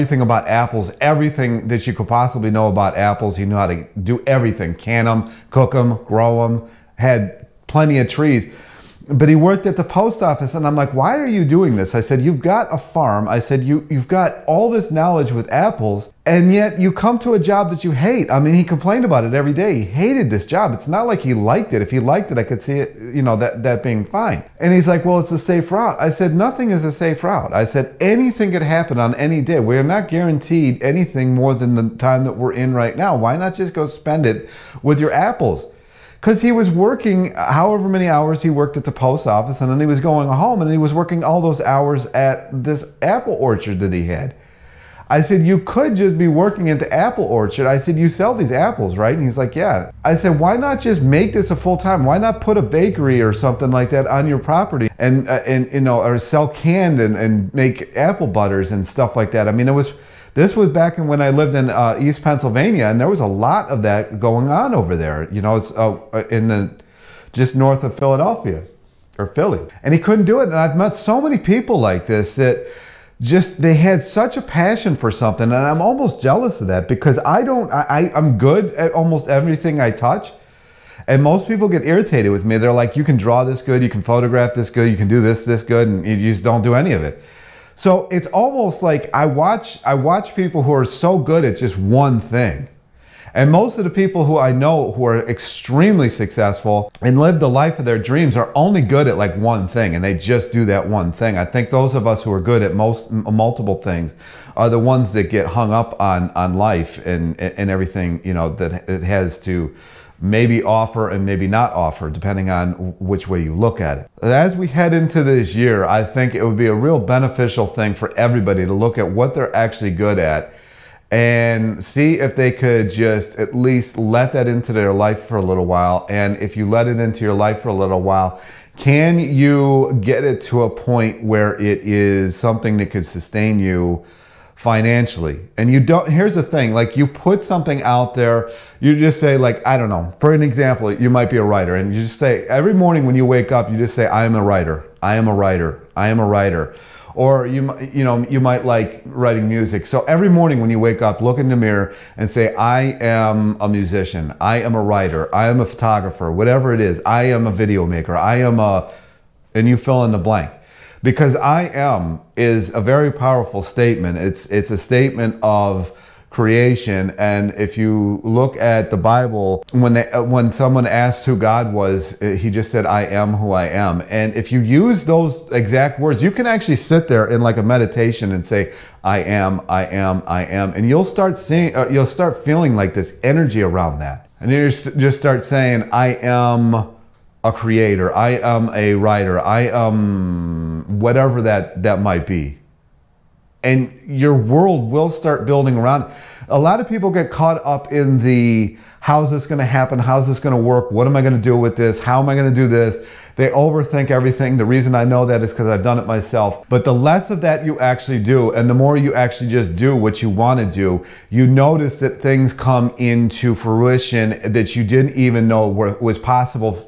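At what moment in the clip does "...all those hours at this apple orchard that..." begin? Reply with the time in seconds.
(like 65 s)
41 s.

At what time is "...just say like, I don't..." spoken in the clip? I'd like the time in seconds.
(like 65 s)
138 s.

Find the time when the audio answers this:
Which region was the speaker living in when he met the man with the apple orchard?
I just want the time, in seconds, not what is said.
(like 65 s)
61 s.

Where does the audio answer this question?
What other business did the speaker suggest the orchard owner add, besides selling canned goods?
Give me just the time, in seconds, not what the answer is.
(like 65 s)
52 s.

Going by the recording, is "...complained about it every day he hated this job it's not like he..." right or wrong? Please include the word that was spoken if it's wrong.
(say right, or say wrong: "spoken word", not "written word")
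right.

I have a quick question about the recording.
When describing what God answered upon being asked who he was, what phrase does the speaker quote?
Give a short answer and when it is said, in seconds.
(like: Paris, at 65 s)
I am who I am, at 172 s.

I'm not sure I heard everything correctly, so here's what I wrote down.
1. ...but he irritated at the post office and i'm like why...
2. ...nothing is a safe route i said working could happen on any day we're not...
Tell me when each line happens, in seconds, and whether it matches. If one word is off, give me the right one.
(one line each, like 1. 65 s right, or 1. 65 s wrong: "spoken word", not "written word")
1. 9 s wrong: "worked", not "irritated"
2. 26 s wrong: "anything", not "working".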